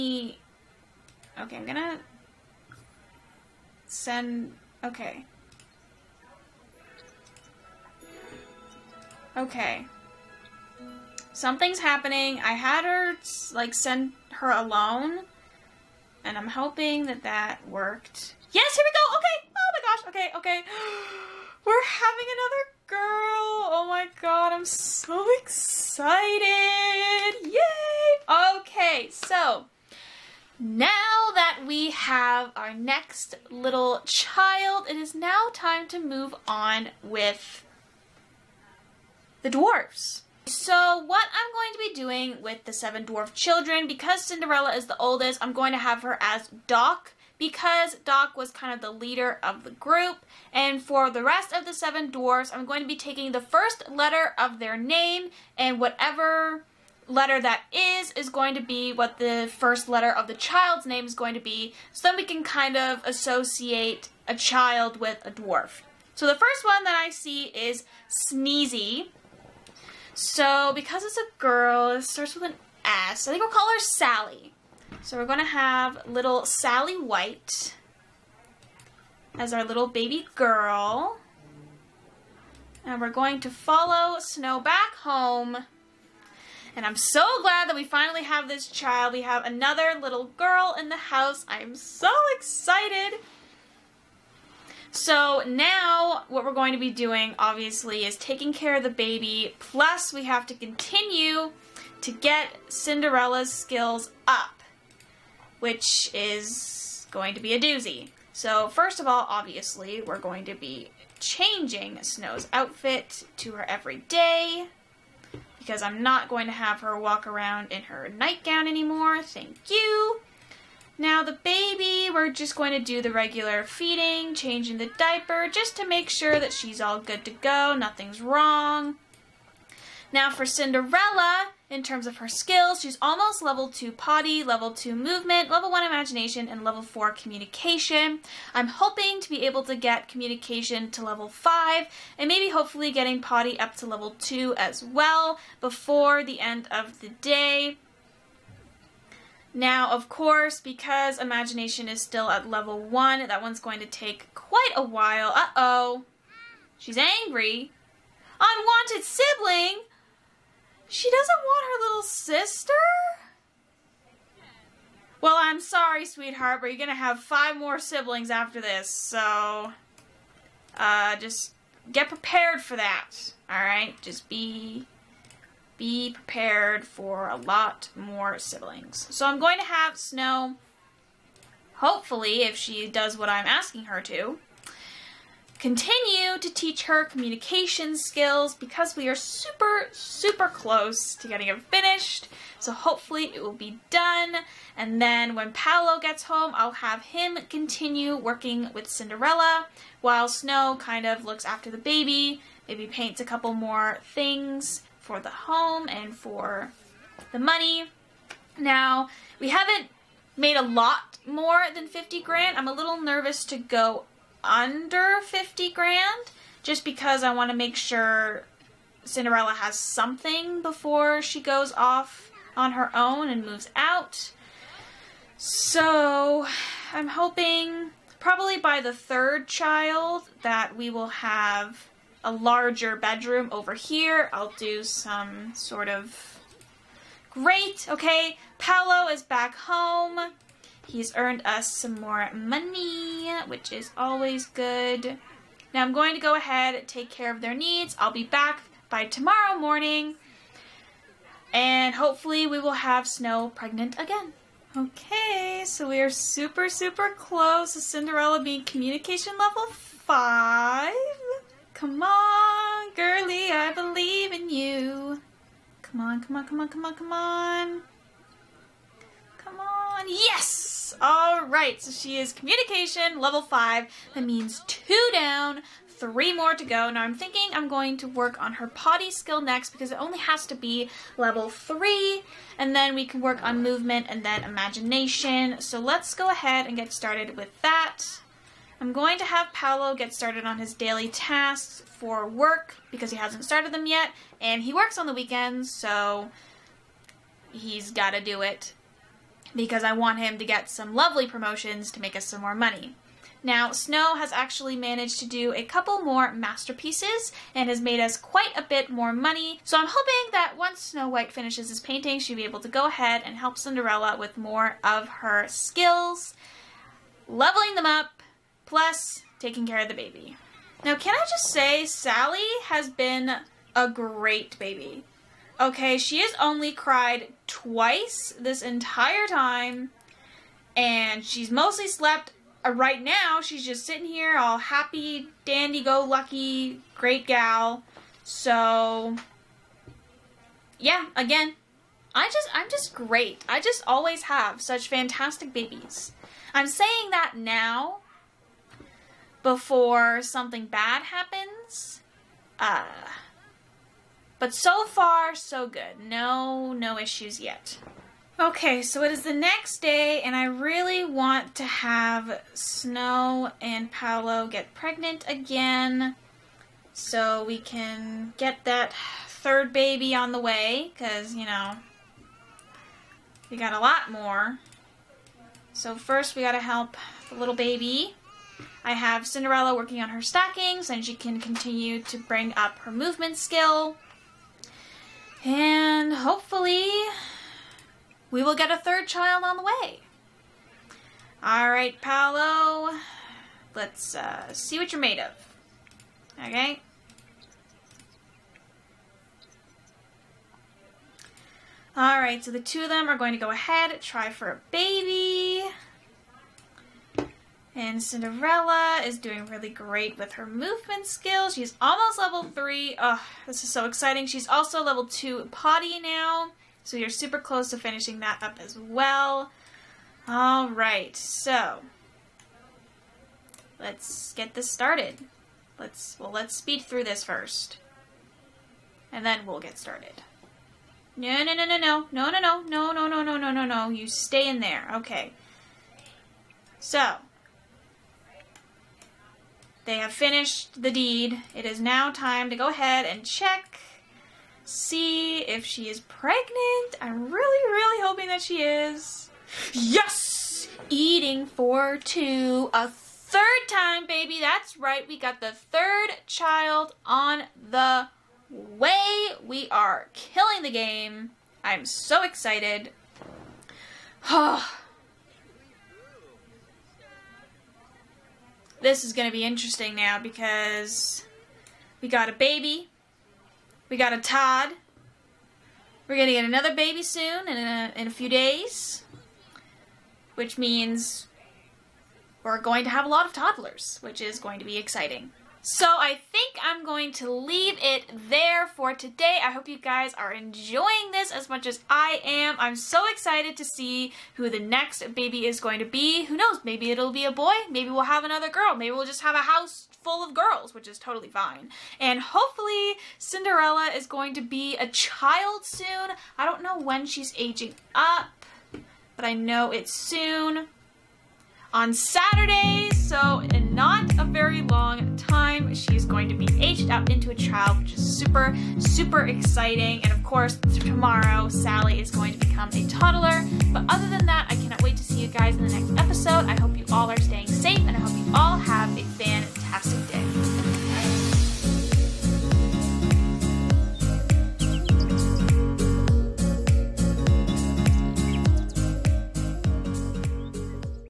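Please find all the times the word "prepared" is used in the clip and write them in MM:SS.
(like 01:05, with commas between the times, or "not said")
02:52, 02:56.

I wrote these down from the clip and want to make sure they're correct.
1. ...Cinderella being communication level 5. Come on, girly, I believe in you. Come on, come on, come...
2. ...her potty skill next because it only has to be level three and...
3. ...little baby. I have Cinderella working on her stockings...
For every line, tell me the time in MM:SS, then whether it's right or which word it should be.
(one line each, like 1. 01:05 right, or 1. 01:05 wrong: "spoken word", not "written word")
1. 04:17 right
2. 04:38 right
3. 06:17 right.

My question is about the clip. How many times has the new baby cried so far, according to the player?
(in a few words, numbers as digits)
twice.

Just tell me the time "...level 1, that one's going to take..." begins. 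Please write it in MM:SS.
02:32.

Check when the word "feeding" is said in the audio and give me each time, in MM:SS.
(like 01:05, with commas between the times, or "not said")
02:03.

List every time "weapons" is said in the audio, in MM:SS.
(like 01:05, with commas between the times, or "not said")
not said.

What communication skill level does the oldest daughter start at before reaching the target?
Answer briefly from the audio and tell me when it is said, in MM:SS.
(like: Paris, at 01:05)
level 4, at 02:16.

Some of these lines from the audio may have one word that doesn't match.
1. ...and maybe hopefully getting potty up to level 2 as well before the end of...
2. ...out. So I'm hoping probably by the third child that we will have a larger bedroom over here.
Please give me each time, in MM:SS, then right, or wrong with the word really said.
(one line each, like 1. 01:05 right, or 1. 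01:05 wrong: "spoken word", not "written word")
1. 02:22 right
2. 03:43 right.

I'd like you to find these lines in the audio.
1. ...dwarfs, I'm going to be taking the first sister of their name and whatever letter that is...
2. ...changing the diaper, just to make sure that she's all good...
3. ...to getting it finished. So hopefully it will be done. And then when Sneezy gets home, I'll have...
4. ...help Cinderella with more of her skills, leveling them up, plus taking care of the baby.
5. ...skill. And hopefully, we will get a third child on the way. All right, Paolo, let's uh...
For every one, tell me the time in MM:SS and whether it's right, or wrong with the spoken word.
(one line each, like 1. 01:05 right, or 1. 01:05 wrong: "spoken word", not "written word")
1. 00:52 wrong: "letter", not "sister"
2. 02:04 right
3. 03:11 wrong: "Paolo", not "Sneezy"
4. 05:13 right
5. 06:23 right.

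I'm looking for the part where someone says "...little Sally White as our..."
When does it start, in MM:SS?
01:16.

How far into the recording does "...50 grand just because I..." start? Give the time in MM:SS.
03:35.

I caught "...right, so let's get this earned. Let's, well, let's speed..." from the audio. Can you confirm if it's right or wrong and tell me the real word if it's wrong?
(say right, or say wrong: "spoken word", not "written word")
wrong: "started", not "earned".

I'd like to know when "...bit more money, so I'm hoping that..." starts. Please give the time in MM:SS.
05:08.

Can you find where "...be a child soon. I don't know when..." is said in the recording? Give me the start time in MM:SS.
08:24.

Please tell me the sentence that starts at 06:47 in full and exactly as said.
And Cinderella is doing really great with her movement skills.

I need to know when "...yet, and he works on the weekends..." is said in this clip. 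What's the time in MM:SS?
04:53.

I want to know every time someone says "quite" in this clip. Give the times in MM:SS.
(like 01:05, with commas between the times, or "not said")
02:34, 05:08.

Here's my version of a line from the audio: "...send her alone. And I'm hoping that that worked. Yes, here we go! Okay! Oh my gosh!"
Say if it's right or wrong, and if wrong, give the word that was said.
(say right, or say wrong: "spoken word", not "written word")
right.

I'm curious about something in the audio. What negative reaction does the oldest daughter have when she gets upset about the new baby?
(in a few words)
Unwanted sibling.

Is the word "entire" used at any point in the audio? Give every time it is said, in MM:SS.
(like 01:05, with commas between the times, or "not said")
05:28.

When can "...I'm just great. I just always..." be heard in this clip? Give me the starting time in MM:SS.
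05:42.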